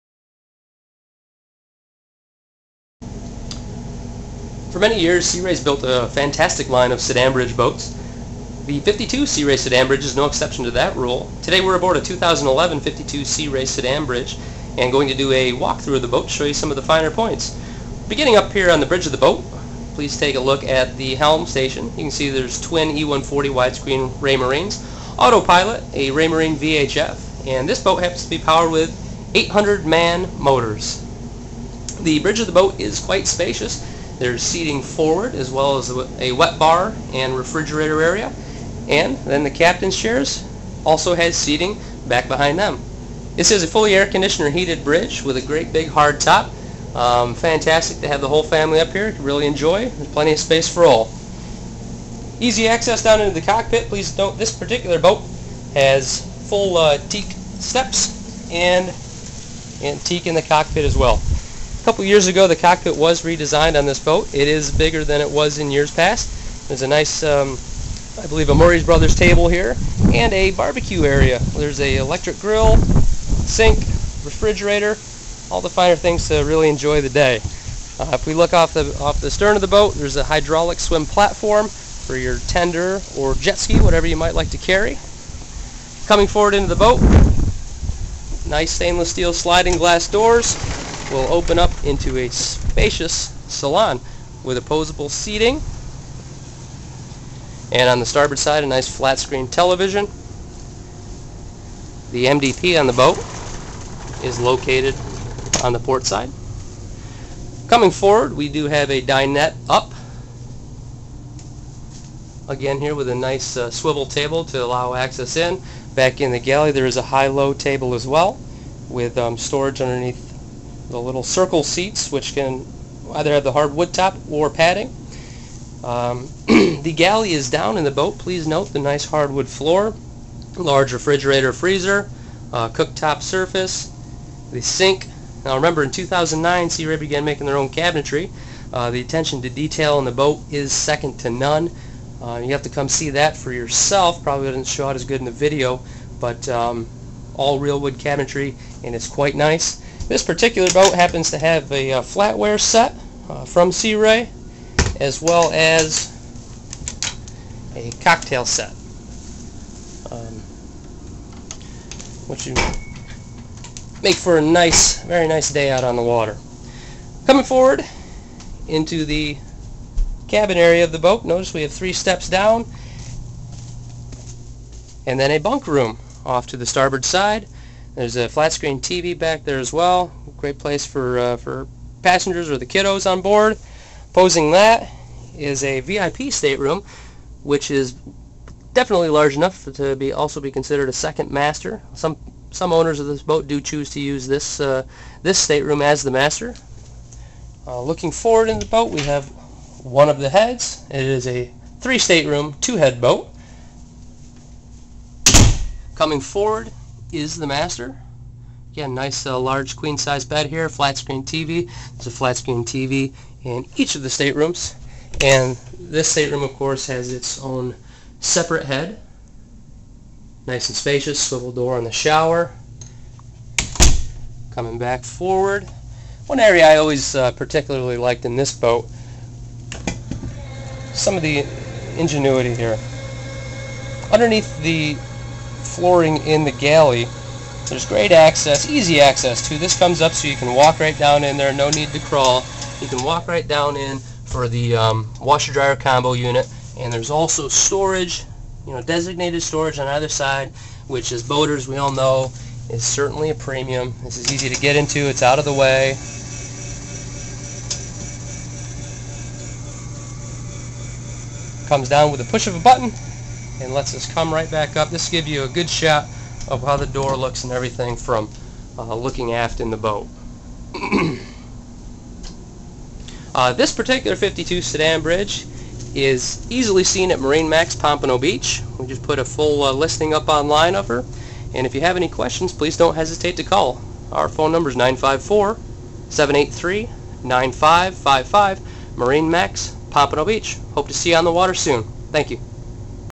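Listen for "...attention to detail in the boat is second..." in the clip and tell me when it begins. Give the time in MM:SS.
02:19.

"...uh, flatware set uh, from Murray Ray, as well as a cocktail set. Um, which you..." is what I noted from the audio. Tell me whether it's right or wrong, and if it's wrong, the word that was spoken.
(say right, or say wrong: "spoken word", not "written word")
wrong: "Sea", not "Murray".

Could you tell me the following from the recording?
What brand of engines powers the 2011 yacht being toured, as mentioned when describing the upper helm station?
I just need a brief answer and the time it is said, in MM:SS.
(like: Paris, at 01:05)
MAN, at 00:29.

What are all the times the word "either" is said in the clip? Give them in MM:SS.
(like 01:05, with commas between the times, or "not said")
02:03, 04:09.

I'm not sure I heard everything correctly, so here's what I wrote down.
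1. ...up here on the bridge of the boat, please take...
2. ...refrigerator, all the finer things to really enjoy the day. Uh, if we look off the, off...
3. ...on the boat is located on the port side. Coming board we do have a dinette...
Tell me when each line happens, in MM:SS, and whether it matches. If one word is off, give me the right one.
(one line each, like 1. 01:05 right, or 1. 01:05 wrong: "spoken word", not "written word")
1. 00:18 right
2. 01:14 right
3. 01:42 wrong: "forward", not "board".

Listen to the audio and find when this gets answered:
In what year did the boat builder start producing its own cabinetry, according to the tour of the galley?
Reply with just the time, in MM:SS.
02:15.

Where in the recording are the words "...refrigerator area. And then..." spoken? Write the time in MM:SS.
00:37.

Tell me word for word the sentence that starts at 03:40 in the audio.
Nice and spacious, swivel door in the shower.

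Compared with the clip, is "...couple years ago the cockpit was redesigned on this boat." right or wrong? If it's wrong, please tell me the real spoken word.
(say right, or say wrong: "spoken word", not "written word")
right.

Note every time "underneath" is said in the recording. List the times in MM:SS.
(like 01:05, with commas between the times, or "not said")
01:59, 03:54.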